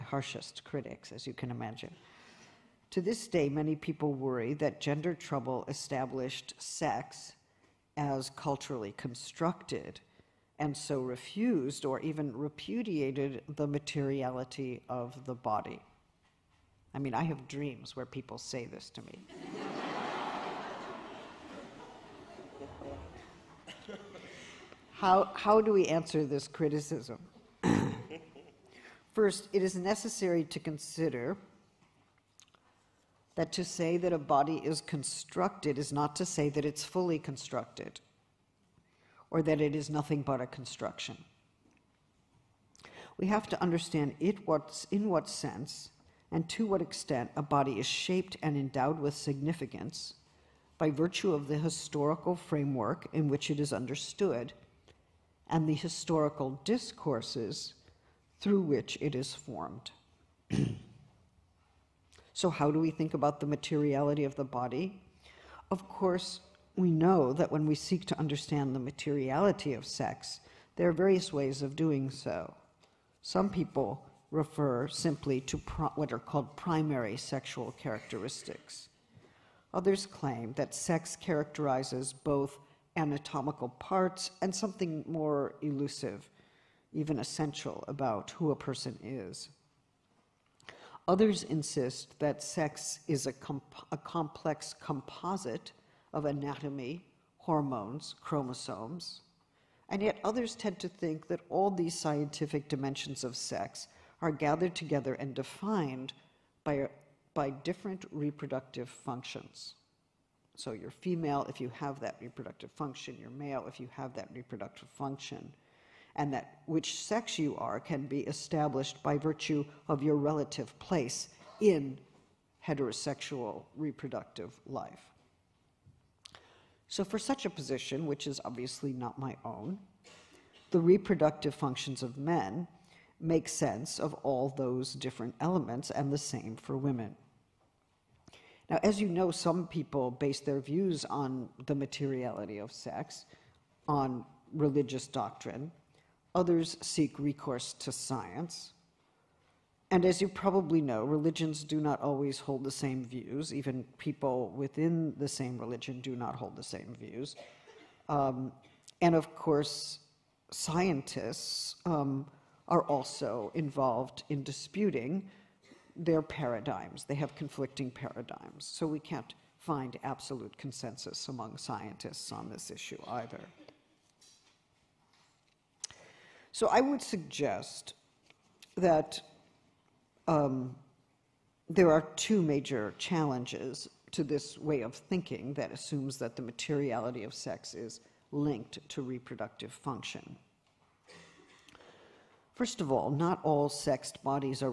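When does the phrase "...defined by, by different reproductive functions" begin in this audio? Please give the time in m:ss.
1:45.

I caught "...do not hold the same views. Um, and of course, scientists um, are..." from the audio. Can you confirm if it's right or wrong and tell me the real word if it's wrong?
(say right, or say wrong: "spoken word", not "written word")
right.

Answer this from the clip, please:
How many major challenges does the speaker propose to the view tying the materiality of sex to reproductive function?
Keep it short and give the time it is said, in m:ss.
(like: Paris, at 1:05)
2, at 3:02.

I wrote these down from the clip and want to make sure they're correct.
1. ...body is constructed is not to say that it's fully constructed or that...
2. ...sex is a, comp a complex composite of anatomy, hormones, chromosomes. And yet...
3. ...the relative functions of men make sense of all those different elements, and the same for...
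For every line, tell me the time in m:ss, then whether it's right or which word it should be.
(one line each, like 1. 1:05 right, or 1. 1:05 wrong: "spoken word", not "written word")
1. 0:34 right
2. 1:32 right
3. 2:10 wrong: "reproductive", not "relative".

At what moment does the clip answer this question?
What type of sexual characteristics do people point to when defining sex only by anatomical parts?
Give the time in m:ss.
1:16.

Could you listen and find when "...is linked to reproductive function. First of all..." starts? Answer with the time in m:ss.
3:07.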